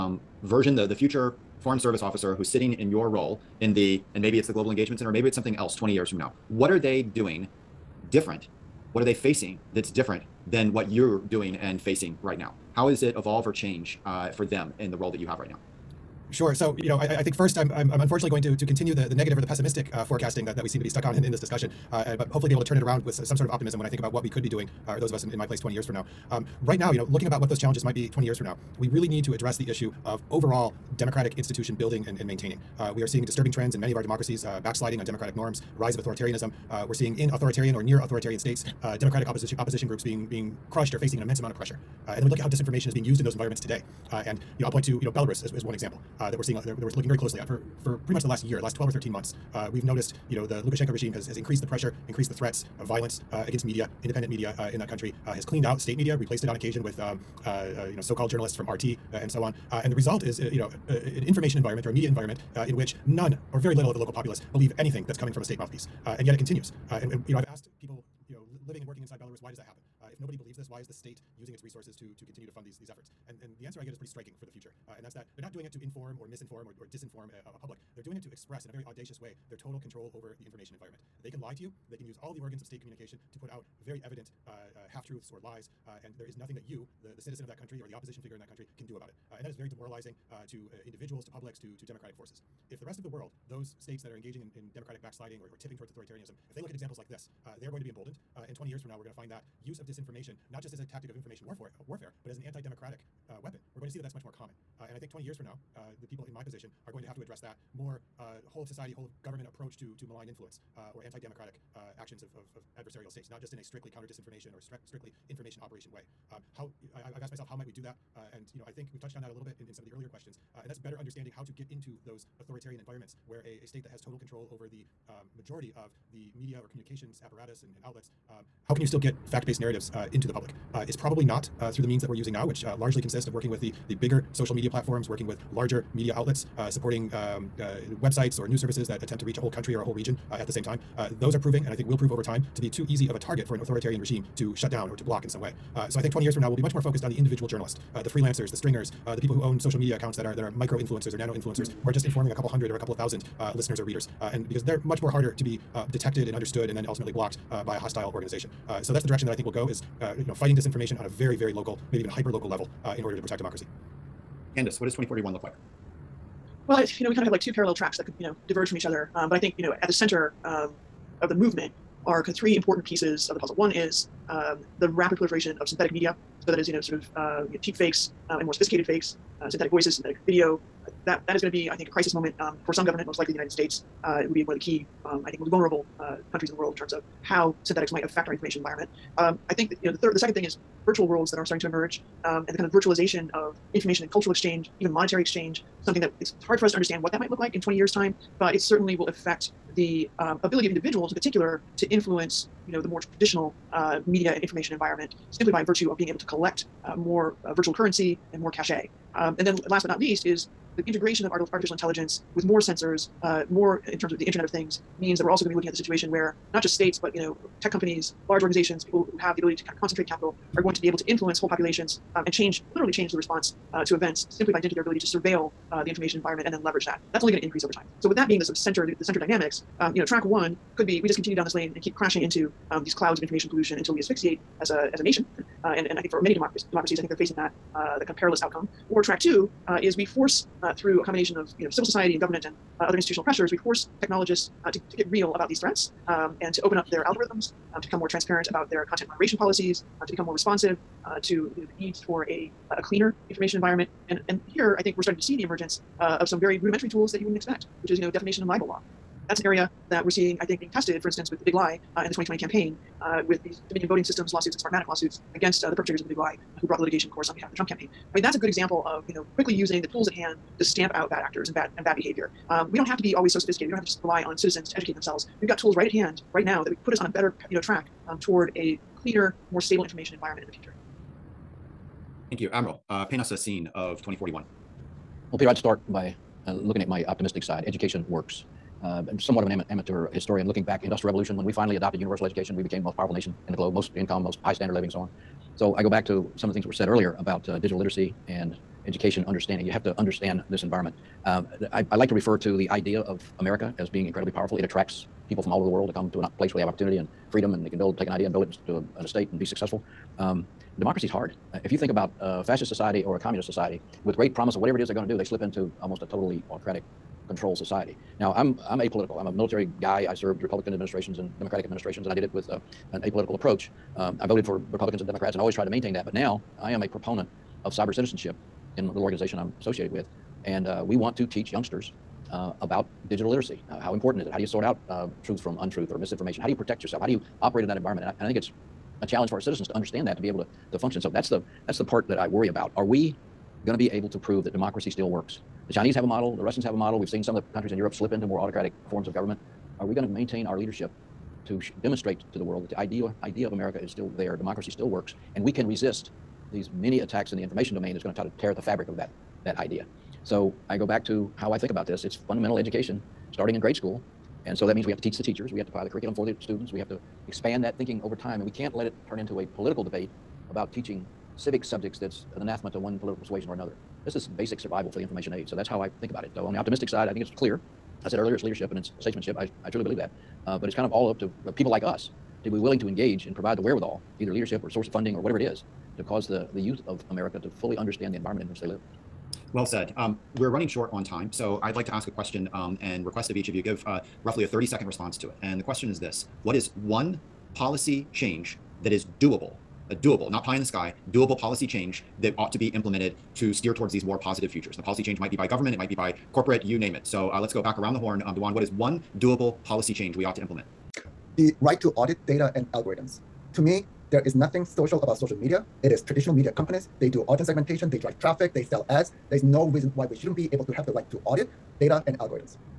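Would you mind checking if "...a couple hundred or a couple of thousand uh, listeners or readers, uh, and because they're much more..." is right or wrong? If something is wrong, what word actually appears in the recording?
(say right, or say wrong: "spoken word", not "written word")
right.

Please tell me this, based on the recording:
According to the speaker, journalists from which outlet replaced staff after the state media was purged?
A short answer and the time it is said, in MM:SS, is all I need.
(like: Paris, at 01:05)
RT, at 00:58.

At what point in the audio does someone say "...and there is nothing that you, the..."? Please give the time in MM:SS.
01:26.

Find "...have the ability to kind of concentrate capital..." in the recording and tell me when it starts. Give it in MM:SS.
03:39.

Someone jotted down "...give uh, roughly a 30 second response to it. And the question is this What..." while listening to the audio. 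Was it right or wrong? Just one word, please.
right.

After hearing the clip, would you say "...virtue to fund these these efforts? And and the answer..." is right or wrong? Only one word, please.
wrong.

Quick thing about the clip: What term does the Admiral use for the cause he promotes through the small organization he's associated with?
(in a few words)
Cyber citizenship.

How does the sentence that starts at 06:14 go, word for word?
This is basic survival for the information age.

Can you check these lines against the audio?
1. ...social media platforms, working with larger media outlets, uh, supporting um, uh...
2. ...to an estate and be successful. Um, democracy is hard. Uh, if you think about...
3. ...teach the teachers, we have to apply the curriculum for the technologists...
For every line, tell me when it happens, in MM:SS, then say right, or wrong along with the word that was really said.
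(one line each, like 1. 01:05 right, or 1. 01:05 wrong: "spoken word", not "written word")
1. 02:14 right
2. 05:08 right
3. 06:05 wrong: "students", not "technologists".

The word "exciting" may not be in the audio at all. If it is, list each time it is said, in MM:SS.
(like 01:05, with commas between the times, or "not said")
not said.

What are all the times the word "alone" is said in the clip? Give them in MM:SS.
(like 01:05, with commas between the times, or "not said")
not said.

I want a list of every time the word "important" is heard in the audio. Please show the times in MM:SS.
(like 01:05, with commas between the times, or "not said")
02:52, 05:33.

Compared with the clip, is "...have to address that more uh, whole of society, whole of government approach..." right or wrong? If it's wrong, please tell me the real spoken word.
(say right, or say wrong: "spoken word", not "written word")
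right.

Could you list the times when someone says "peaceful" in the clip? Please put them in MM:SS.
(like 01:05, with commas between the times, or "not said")
not said.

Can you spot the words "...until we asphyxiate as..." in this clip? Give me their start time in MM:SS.
03:53.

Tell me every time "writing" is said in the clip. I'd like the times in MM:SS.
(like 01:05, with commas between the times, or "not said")
not said.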